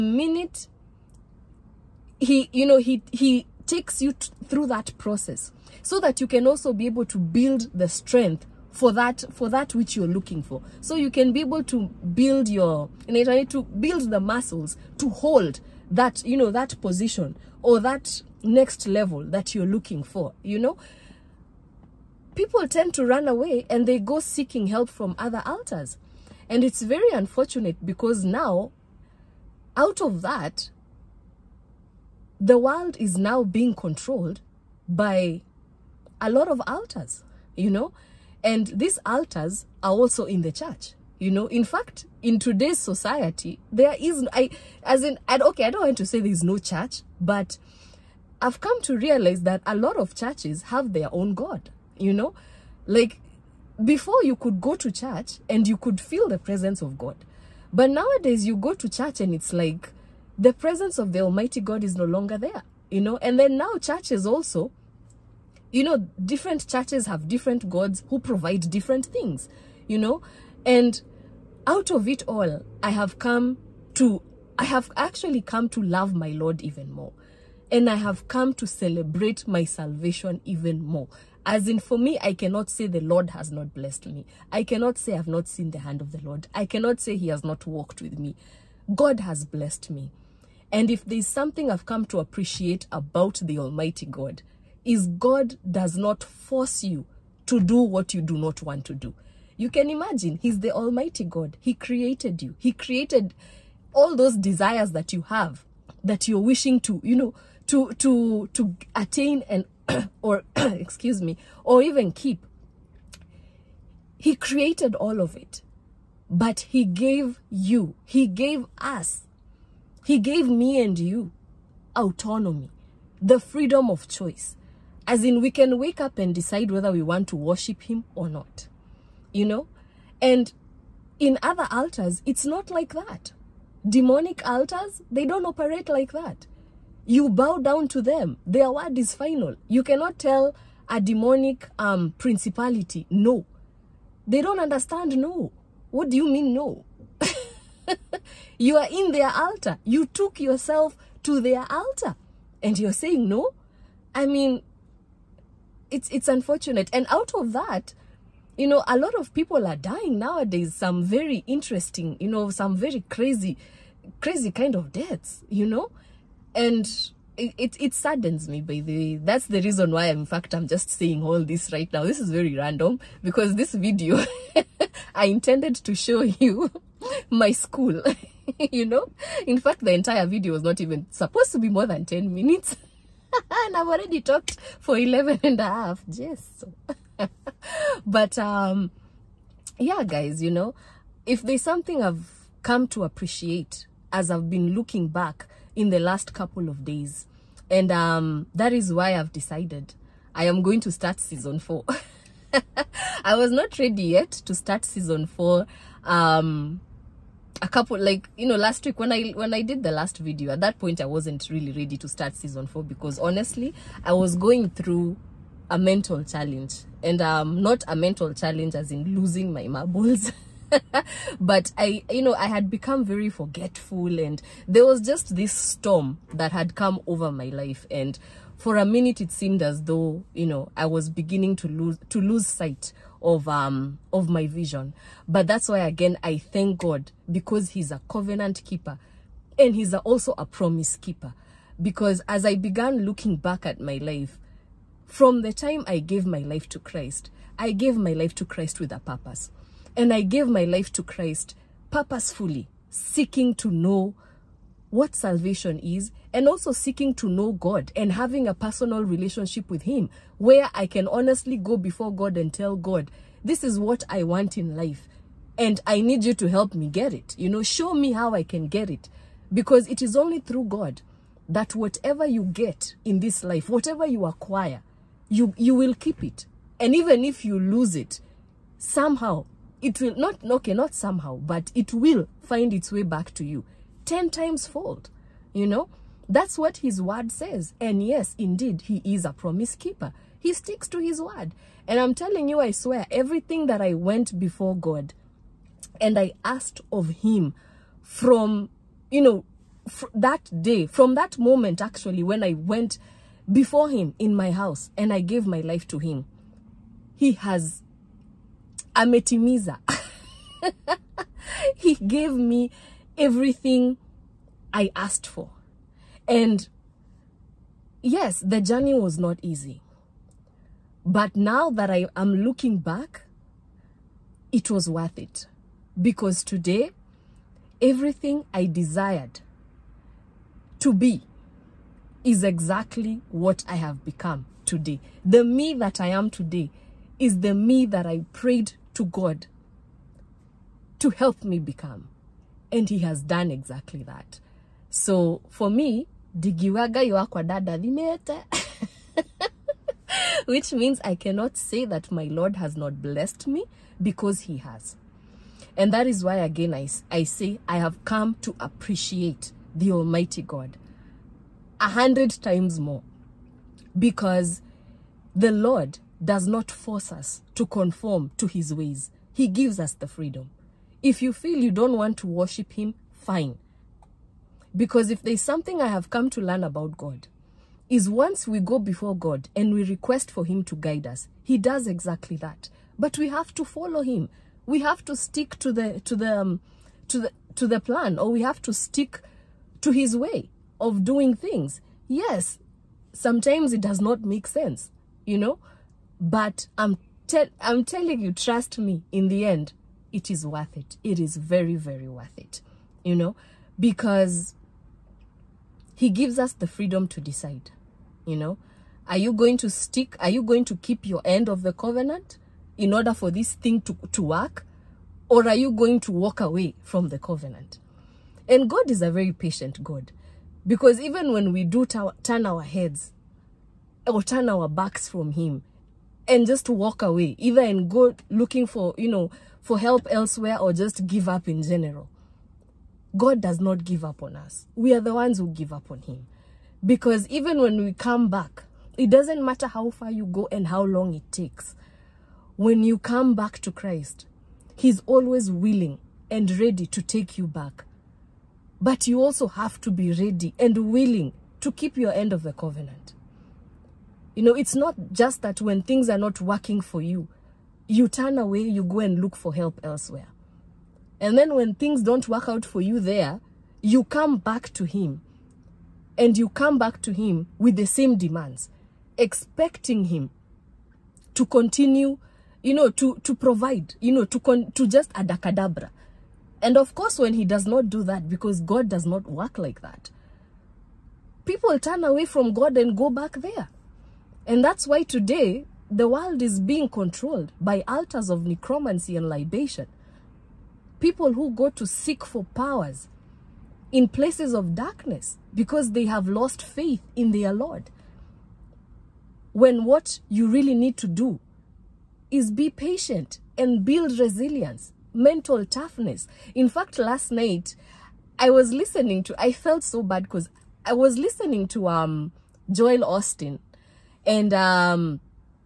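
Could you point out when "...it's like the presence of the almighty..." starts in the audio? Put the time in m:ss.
0:59.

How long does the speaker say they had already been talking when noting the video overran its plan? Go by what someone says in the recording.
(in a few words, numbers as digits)
11 and a half minutes.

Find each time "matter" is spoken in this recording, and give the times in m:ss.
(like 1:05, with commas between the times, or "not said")
7:19.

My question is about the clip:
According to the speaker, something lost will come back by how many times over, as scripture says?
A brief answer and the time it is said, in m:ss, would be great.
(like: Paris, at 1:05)
10 times, at 4:44.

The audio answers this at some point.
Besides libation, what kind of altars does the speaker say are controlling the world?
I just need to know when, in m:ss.
8:08.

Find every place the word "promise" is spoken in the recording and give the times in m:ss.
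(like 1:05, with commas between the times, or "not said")
4:00, 4:49.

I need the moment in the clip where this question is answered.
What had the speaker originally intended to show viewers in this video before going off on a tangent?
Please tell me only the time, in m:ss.
2:57.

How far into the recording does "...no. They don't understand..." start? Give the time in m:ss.
2:23.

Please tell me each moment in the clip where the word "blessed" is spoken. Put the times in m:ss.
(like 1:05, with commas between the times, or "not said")
1:23, 1:29, 5:53.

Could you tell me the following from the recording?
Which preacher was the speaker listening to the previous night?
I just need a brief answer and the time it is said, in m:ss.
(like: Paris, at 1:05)
Joel Osteen, at 8:32.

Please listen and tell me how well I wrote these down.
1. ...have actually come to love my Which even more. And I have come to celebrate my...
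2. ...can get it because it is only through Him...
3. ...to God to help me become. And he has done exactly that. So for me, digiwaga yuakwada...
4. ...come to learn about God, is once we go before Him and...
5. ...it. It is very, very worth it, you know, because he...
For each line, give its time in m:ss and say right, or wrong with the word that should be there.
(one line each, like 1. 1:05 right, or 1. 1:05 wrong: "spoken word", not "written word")
1. 1:14 wrong: "Lord", not "Which"
2. 4:28 wrong: "God", not "Him"
3. 5:38 right
4. 6:16 wrong: "God", not "Him"
5. 6:40 right.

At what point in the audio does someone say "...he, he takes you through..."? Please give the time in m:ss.
0:02.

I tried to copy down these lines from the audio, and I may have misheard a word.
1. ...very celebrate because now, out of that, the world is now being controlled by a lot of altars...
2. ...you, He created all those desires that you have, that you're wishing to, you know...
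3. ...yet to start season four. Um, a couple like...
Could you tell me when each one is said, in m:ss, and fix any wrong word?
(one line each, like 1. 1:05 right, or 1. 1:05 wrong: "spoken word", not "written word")
1. 0:26 wrong: "unfortunate", not "celebrate"
2. 1:42 right
3. 3:24 right.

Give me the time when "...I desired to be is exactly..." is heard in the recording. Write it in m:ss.
5:28.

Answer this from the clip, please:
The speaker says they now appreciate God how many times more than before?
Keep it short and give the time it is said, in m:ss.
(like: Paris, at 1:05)
A hundred times, at 6:01.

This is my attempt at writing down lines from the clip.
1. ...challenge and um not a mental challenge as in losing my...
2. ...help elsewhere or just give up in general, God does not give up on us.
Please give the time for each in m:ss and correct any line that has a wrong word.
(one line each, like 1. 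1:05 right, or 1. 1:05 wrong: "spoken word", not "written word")
1. 3:36 right
2. 7:09 right.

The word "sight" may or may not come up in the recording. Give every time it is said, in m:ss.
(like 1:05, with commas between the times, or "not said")
3:52.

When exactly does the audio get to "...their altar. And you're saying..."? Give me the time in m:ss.
2:31.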